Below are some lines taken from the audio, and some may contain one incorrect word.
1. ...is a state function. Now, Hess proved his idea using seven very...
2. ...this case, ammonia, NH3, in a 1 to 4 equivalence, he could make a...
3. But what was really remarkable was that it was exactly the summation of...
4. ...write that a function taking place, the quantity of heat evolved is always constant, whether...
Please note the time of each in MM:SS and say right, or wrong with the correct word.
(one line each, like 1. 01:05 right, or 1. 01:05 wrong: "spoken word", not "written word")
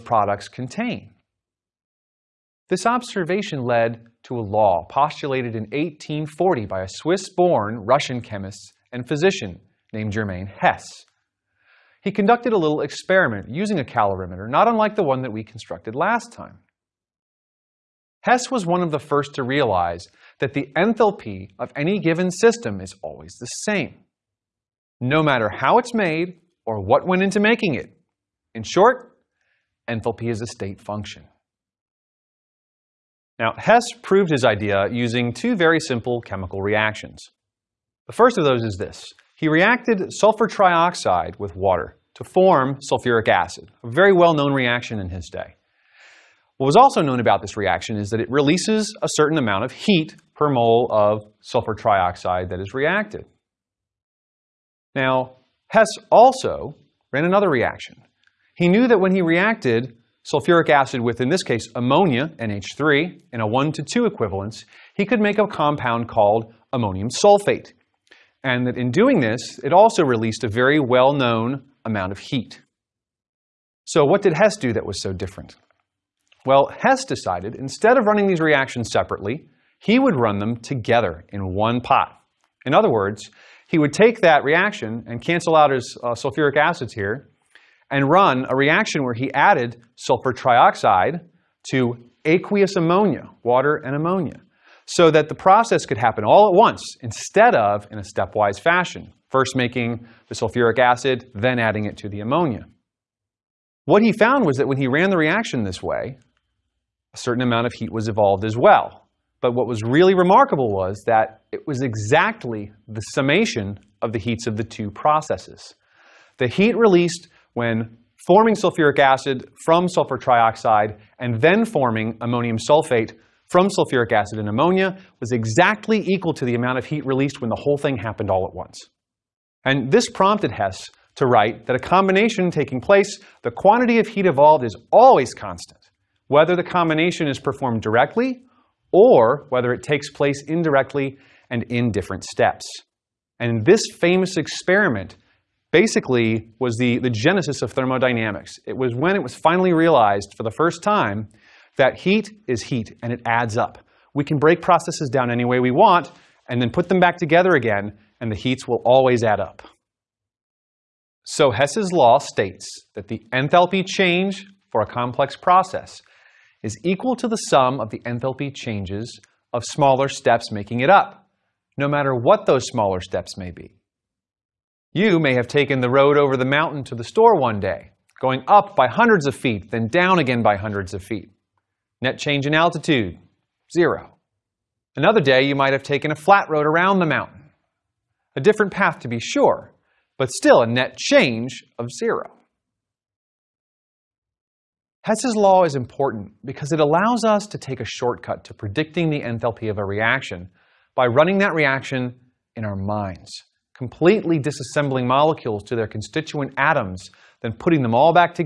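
1. 00:30 wrong: "two", not "seven"
2. 01:01 wrong: "2", not "4"
3. 01:49 right
4. 02:11 wrong: "combination", not "function".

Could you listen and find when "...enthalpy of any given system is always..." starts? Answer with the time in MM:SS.
00:20.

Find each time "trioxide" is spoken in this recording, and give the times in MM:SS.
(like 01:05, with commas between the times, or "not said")
00:40, 00:51, 01:30, 02:00.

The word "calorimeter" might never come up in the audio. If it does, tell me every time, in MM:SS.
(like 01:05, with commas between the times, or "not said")
00:13.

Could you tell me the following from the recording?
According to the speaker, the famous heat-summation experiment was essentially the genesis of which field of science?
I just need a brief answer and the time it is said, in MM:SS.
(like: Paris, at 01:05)
thermodynamics, at 02:27.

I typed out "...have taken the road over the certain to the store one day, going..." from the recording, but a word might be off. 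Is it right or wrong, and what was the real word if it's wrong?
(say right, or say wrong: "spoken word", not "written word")
wrong: "mountain", not "certain".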